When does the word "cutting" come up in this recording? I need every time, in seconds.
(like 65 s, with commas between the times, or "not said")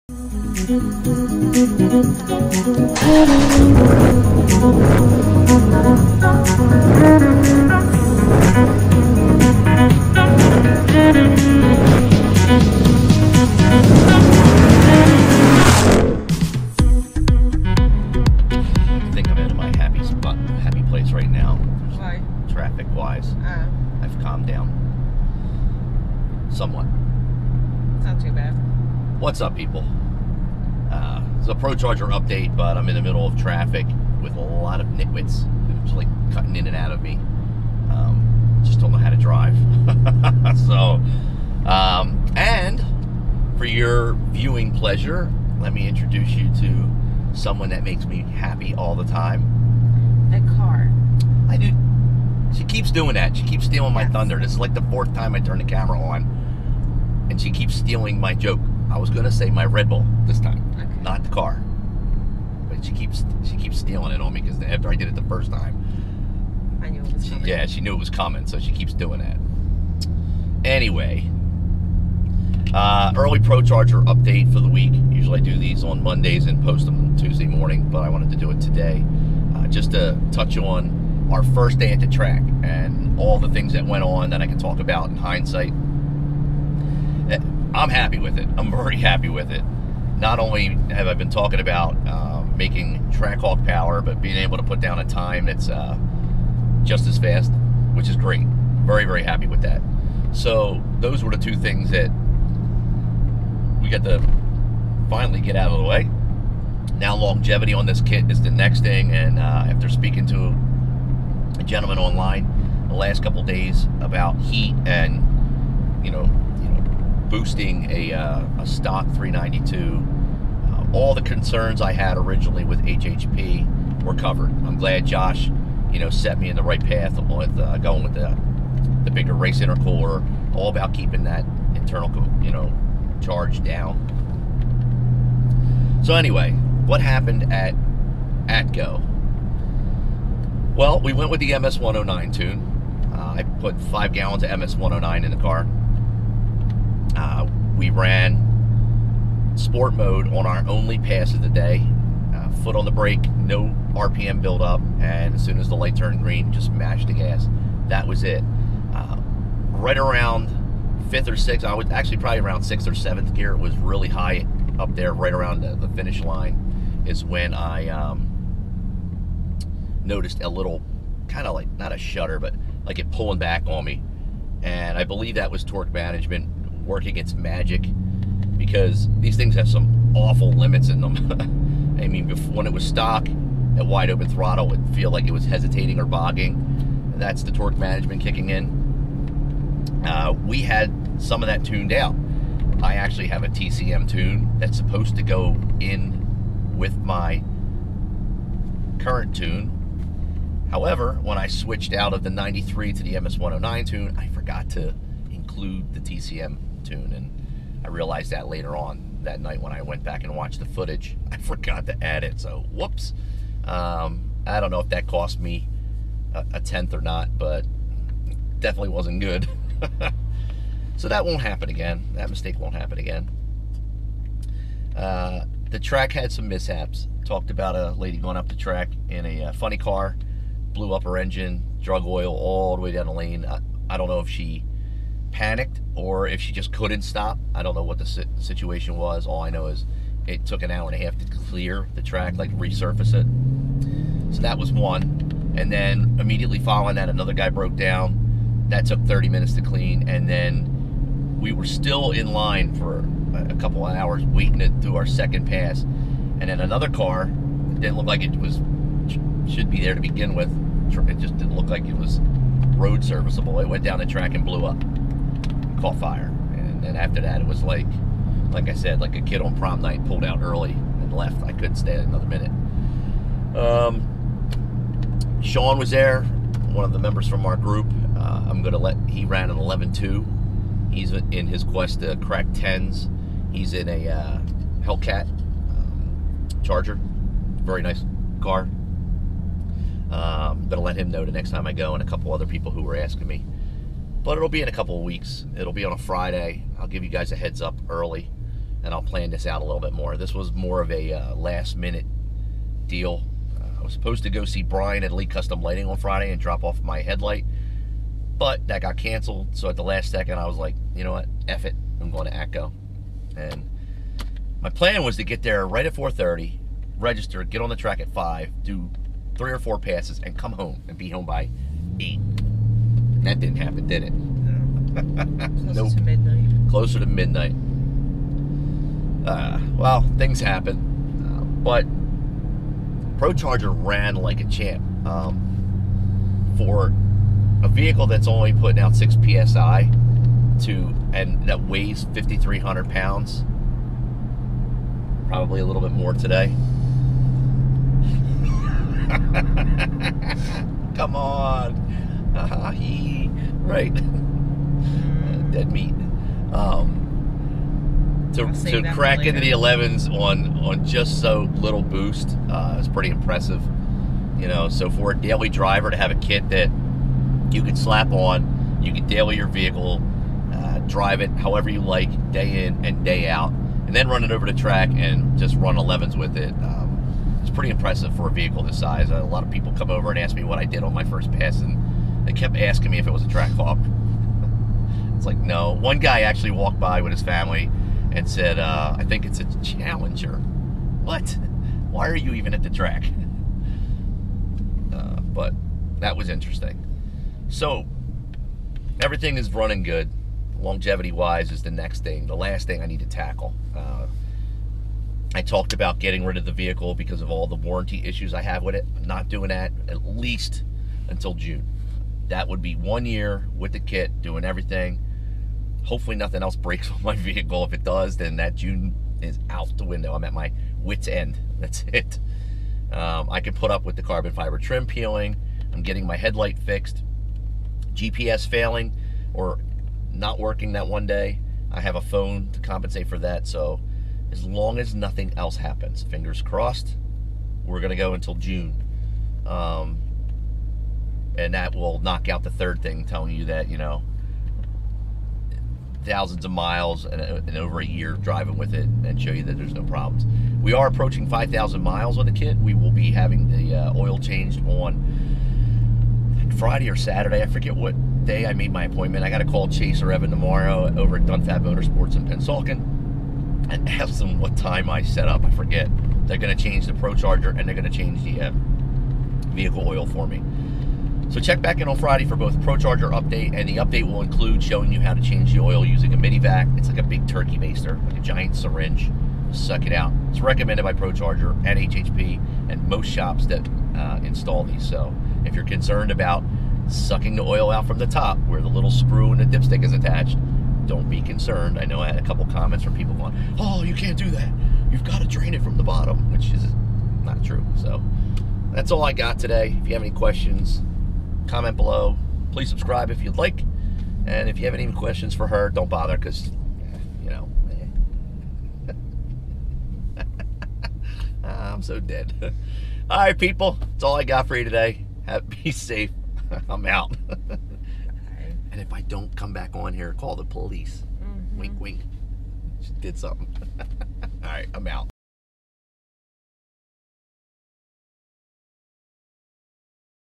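36 s.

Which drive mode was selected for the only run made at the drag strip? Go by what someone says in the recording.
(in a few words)
sport mode.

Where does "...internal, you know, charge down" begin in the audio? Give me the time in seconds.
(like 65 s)
131 s.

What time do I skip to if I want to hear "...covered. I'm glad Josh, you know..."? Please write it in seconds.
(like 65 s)
124 s.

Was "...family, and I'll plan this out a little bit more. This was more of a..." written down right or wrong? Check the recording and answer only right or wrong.
wrong.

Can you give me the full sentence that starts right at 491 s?
I know I had a couple comments from people going, oh, you can't do that.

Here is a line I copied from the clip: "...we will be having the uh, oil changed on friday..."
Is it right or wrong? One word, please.
right.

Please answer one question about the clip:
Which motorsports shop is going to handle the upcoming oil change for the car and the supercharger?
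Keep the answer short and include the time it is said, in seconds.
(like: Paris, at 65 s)
Dunfab Motorsports, at 461 s.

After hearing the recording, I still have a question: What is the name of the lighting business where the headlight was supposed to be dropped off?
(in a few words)
Lee Custom Lighting.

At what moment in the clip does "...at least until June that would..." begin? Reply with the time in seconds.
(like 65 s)
409 s.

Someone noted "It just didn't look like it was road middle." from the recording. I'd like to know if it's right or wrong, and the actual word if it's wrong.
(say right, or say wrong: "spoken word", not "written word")
wrong: "serviceable", not "middle".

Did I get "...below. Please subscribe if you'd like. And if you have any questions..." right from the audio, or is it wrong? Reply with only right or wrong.
right.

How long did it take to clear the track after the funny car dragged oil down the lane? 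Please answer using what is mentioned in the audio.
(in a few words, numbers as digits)
an hour and a half.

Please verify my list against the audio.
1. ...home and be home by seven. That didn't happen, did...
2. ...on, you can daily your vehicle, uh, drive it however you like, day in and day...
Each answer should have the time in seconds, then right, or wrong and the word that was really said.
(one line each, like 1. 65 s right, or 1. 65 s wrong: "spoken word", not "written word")
1. 320 s wrong: "eight", not "seven"
2. 368 s right.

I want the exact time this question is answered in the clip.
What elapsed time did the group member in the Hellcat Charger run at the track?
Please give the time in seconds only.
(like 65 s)
279 s.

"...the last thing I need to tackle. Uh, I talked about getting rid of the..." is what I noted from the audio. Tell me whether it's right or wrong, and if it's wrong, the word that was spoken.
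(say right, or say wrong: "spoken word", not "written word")
right.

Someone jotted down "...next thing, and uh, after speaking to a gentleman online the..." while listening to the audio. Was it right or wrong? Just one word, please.
right.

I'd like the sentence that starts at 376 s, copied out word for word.
Um, it's pretty impressive for a vehicle this size.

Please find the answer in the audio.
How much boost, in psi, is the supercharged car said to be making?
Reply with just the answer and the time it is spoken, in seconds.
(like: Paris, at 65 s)
6 psi, at 338 s.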